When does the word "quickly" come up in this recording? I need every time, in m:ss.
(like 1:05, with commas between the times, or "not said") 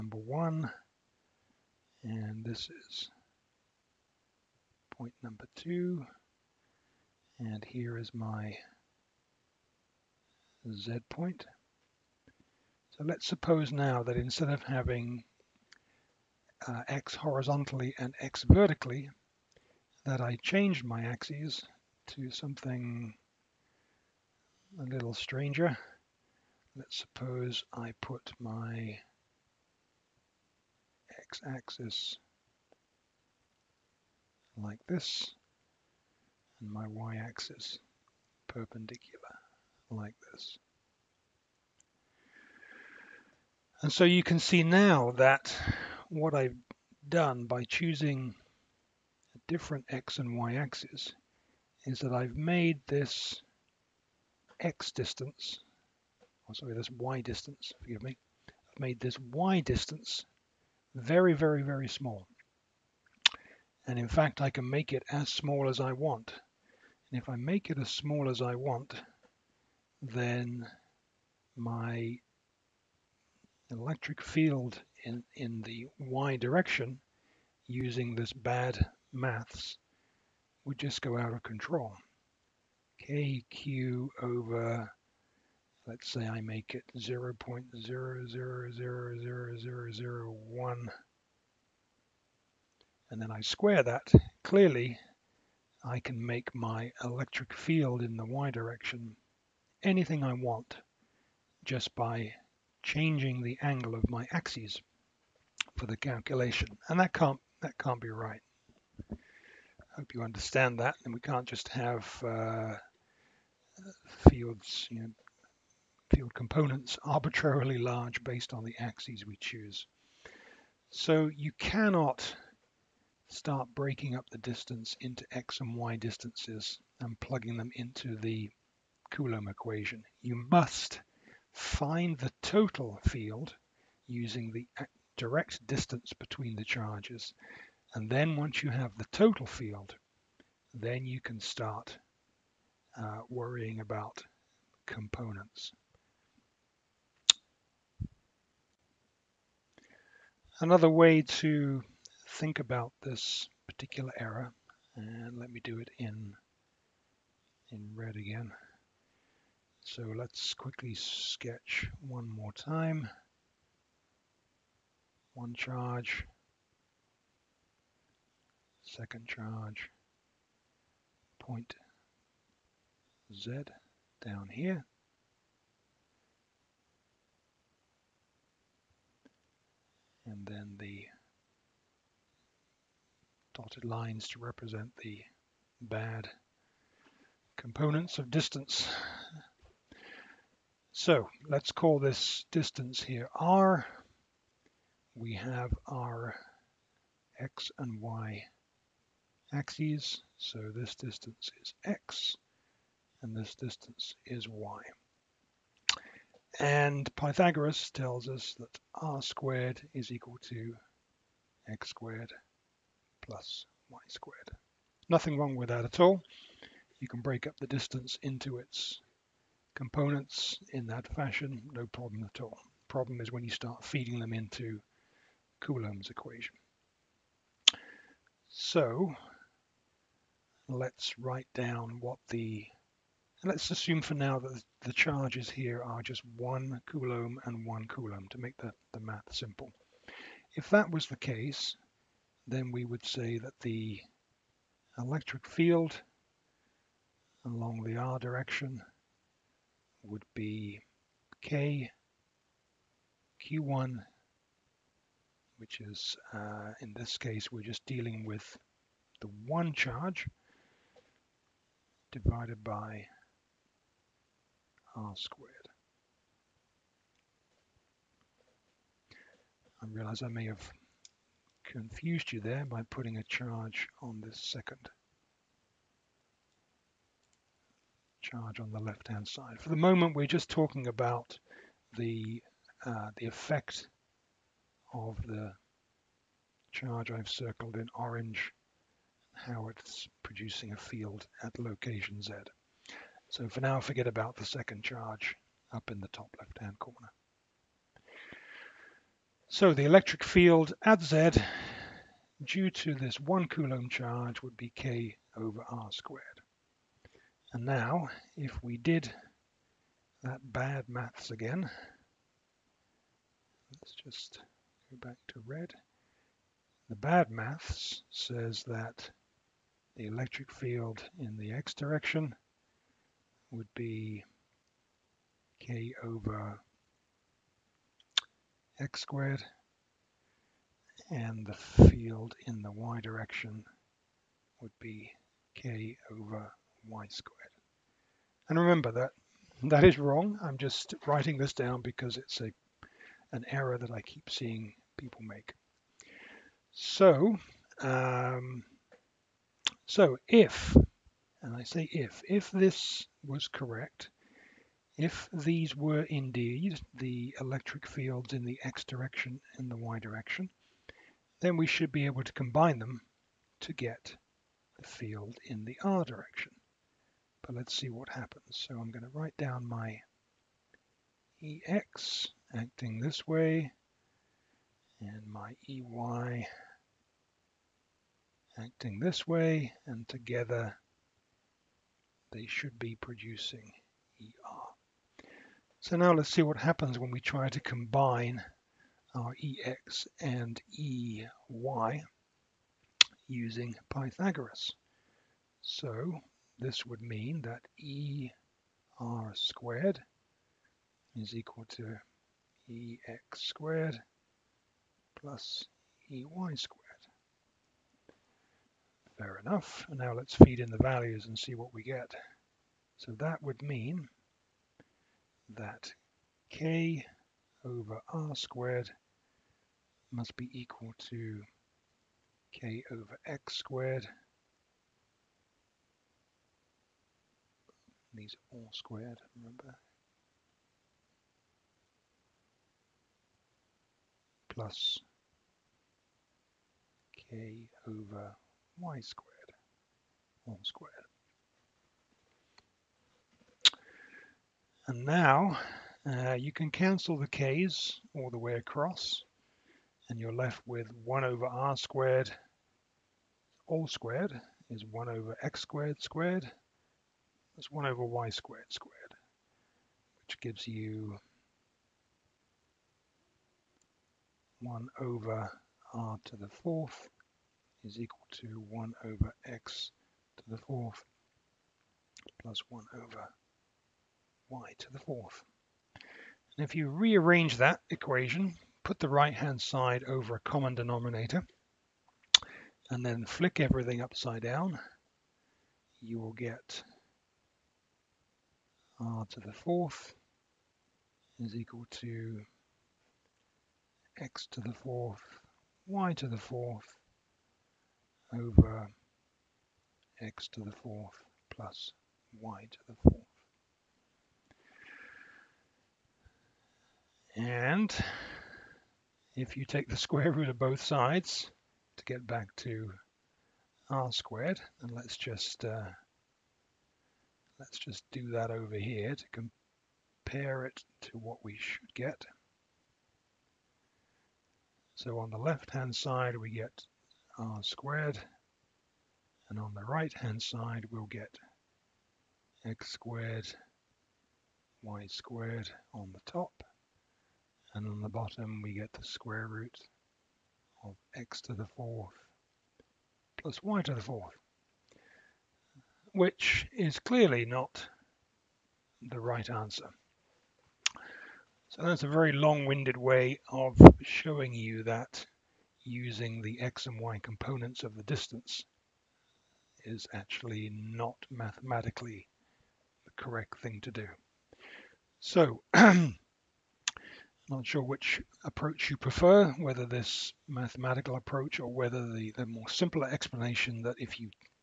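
2:40.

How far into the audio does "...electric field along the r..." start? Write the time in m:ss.
4:04.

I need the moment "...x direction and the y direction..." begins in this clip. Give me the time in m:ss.
5:58.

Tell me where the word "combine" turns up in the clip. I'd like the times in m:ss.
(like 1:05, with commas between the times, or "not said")
6:02, 6:27.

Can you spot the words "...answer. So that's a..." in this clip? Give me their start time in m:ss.
9:09.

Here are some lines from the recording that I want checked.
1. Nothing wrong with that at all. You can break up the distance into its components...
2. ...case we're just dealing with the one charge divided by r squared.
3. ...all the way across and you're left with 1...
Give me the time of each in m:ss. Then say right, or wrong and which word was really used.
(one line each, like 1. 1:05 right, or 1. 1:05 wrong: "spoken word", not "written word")
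1. 3:35 right
2. 4:17 right
3. 7:28 right.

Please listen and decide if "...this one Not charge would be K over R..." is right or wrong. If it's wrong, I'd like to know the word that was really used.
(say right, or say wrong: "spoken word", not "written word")
wrong: "Coulomb", not "Not".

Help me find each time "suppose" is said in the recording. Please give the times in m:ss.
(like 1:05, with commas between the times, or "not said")
0:13, 0:26.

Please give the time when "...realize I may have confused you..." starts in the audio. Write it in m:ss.
4:29.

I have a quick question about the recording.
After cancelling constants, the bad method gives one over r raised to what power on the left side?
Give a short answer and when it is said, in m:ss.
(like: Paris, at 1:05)
4, at 7:44.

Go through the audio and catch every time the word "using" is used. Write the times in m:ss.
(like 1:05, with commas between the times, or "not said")
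1:17, 2:14, 6:33, 9:15.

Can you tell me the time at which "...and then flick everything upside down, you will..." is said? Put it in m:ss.
8:02.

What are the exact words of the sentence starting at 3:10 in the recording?
So let's call this distance here r.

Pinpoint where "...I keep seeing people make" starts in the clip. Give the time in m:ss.
5:43.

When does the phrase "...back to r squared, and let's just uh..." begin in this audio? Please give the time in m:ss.
8:32.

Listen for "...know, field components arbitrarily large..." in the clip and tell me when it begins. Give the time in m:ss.
1:55.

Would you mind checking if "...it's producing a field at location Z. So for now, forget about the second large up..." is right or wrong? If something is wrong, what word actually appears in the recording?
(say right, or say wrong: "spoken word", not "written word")
wrong: "charge", not "large".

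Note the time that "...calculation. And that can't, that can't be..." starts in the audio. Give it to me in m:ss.
1:45.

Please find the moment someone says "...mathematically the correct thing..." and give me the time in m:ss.
9:21.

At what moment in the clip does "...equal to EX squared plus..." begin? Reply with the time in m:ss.
6:41.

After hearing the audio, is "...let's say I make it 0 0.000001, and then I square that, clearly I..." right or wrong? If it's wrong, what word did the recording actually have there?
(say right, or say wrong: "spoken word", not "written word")
right.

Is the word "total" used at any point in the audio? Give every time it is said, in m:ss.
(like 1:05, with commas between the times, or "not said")
2:12, 2:19.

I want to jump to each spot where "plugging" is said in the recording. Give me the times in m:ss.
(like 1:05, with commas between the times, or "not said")
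2:07.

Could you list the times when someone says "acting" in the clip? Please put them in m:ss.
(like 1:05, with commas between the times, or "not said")
6:12, 6:18.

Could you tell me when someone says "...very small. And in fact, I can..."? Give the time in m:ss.
1:01.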